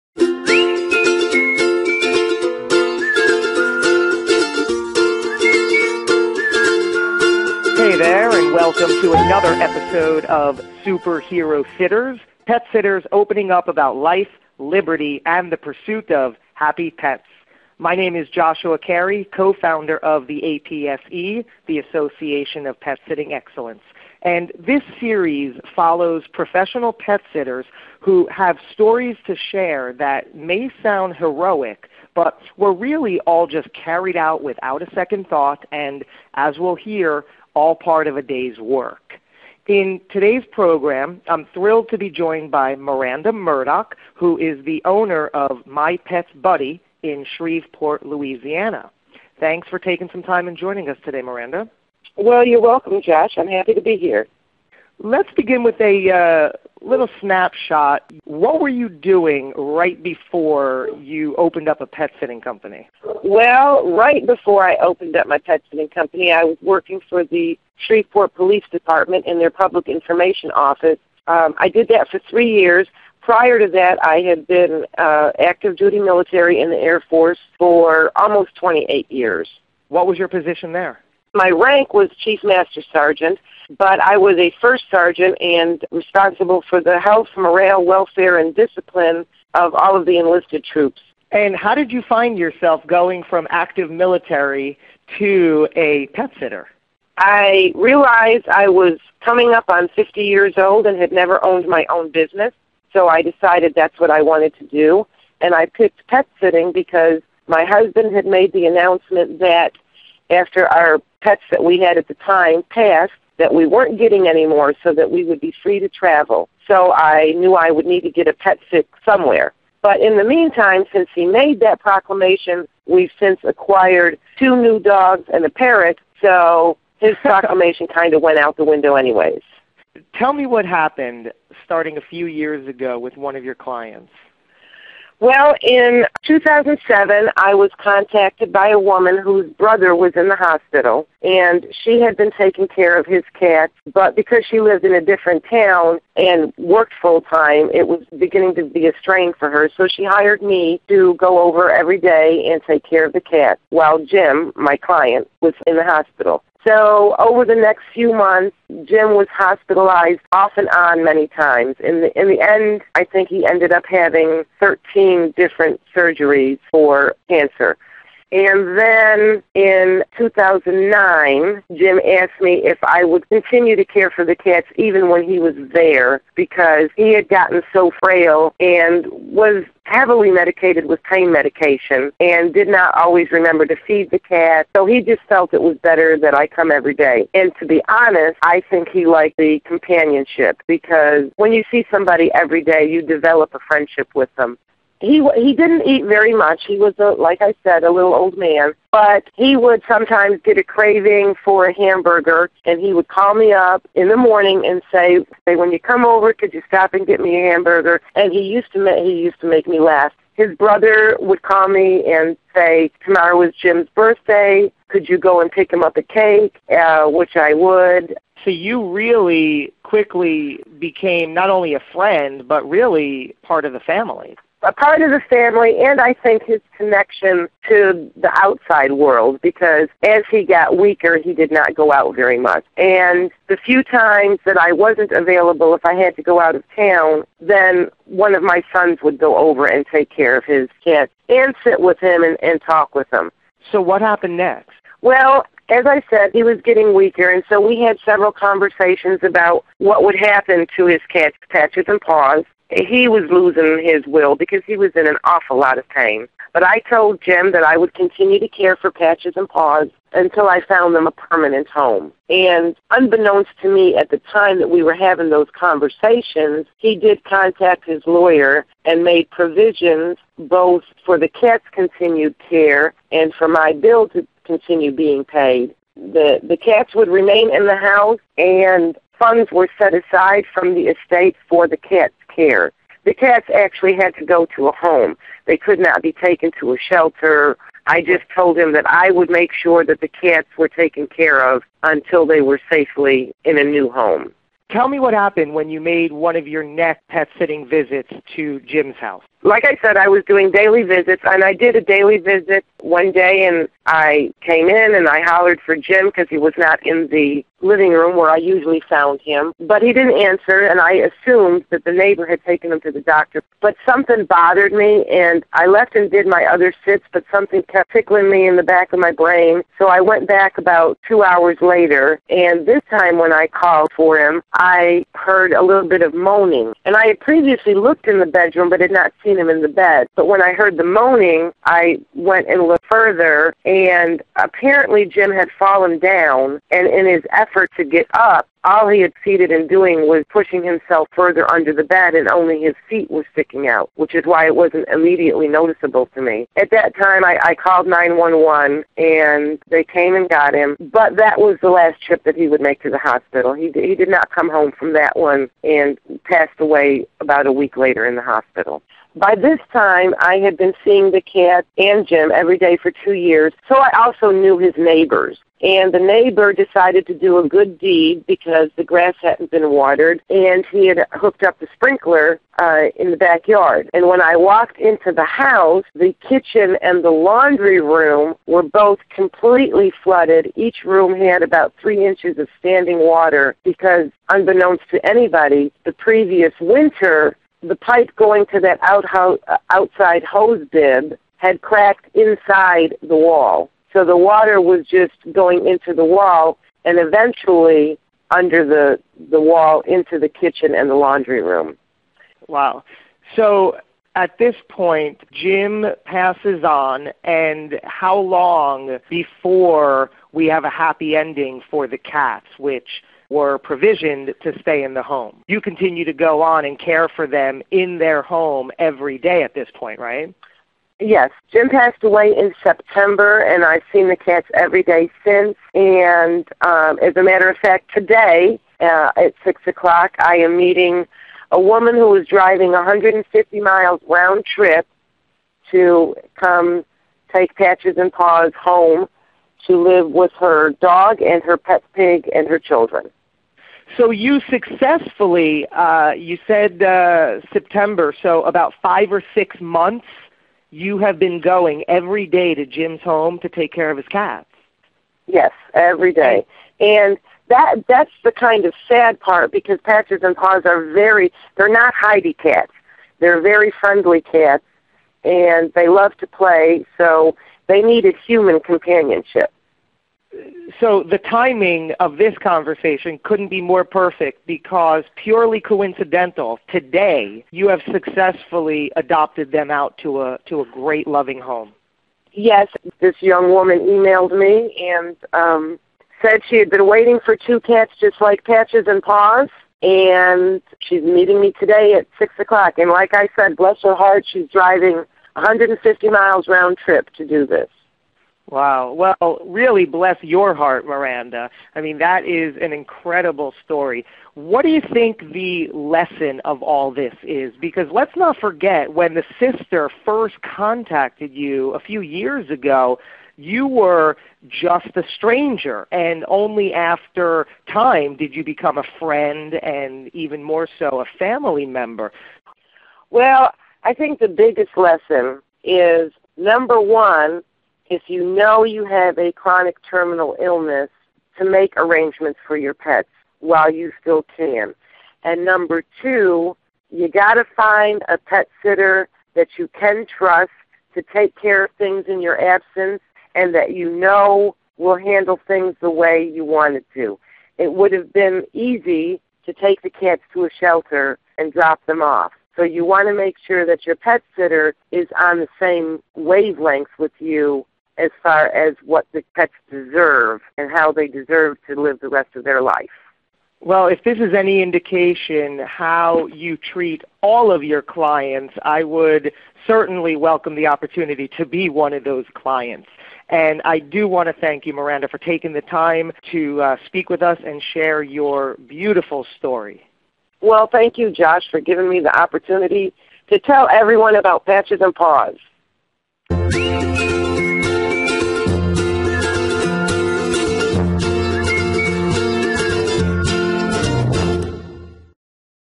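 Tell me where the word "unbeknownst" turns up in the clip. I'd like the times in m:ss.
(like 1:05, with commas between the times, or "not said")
4:22, 6:24.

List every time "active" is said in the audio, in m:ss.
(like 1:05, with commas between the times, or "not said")
1:15, 1:33.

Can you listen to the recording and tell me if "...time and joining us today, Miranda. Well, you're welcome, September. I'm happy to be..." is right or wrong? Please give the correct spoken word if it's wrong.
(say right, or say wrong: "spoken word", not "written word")
wrong: "Josh", not "September".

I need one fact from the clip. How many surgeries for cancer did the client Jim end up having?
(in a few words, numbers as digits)
13.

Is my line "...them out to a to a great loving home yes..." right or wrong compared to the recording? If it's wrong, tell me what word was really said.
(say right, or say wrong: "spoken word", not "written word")
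right.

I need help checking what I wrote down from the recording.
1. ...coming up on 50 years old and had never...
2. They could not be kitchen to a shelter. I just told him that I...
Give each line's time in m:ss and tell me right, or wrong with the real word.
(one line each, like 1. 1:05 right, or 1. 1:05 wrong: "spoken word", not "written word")
1. 1:39 right
2. 4:45 wrong: "taken", not "kitchen".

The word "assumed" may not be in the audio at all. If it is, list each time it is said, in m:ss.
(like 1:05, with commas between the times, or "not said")
5:10.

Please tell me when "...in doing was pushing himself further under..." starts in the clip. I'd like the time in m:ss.
5:39.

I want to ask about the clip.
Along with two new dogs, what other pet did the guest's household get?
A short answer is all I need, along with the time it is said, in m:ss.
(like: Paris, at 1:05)
Parrot, at 2:05.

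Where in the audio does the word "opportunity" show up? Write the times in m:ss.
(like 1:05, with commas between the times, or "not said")
9:30, 9:42.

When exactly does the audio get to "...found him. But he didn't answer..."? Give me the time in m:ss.
5:08.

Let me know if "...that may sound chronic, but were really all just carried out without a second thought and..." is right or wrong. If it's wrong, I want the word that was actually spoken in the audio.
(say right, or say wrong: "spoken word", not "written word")
wrong: "heroic", not "chronic".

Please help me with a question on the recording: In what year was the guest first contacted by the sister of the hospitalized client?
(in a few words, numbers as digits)
2007.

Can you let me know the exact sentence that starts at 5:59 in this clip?
By this time, I had been seeing the cat and Jim every day for two years, so I also knew his neighbors.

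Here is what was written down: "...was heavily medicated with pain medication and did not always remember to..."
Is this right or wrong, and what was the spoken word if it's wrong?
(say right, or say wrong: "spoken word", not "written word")
right.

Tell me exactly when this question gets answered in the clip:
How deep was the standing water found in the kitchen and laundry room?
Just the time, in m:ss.
6:21.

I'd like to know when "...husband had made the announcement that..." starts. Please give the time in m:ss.
1:47.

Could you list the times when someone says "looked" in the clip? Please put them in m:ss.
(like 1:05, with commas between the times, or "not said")
5:27, 5:32.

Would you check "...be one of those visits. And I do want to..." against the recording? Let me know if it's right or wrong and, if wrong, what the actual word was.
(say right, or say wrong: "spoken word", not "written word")
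wrong: "clients", not "visits".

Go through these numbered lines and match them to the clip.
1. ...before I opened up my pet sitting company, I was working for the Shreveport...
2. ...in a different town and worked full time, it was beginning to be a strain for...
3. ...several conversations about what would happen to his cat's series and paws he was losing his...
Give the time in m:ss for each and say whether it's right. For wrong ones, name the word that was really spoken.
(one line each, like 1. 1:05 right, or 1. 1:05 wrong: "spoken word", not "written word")
1. 1:04 right
2. 2:24 right
3. 4:08 wrong: "patches", not "series".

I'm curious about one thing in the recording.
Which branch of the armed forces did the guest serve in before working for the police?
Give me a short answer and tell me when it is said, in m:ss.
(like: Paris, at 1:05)
Air Force, at 1:16.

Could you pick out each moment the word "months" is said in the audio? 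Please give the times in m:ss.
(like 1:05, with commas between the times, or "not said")
2:38, 7:29.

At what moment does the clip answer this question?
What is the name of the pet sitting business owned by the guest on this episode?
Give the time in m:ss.
0:45.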